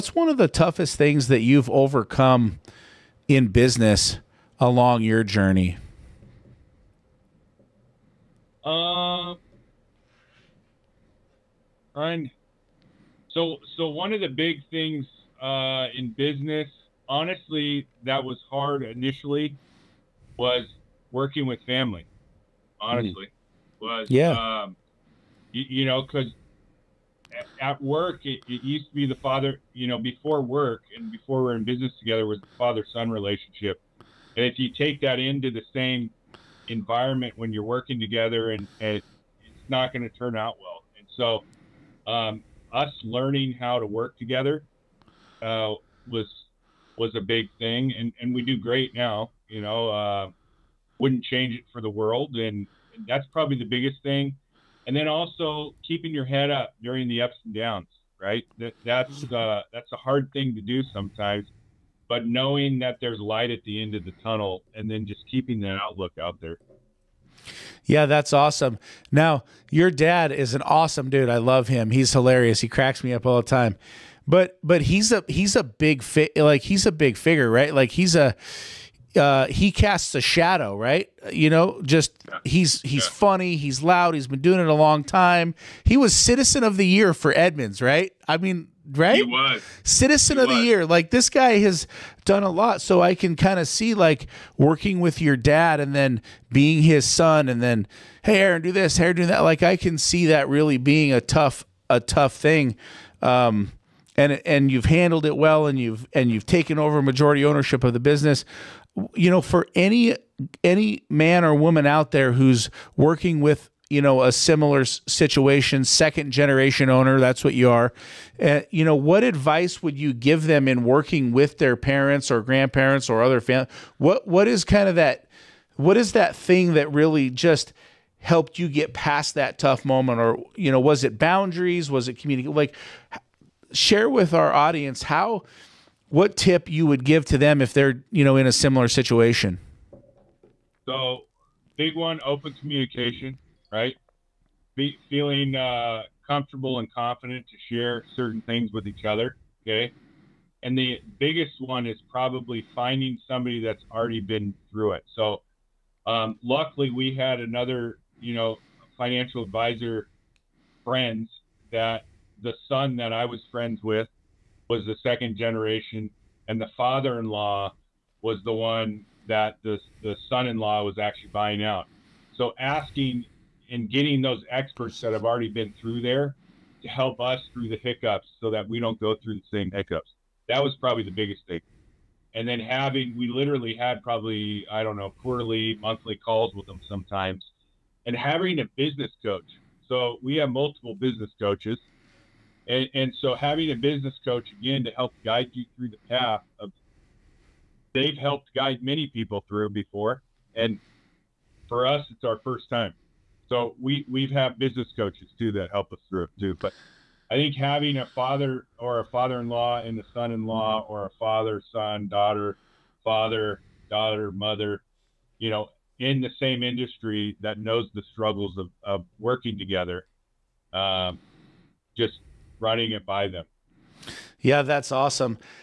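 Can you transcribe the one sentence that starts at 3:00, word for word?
That was probably the biggest thing.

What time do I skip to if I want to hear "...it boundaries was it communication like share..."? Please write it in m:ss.
2:11.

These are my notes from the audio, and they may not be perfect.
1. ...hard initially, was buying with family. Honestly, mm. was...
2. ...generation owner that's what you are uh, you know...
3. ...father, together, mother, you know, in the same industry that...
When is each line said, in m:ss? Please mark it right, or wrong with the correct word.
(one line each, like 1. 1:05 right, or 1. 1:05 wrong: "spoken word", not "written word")
1. 0:18 wrong: "working", not "buying"
2. 1:56 right
3. 3:33 wrong: "daughter", not "together".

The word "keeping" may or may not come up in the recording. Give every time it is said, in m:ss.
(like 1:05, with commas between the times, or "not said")
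0:55, 1:05.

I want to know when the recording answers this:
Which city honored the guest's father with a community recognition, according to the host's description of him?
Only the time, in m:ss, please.
1:27.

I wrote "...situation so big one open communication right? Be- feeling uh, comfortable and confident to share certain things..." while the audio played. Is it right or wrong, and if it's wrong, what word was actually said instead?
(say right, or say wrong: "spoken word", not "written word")
right.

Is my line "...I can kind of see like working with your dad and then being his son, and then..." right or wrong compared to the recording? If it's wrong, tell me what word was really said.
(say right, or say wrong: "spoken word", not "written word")
right.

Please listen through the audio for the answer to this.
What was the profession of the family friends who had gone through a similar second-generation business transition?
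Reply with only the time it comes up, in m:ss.
2:38.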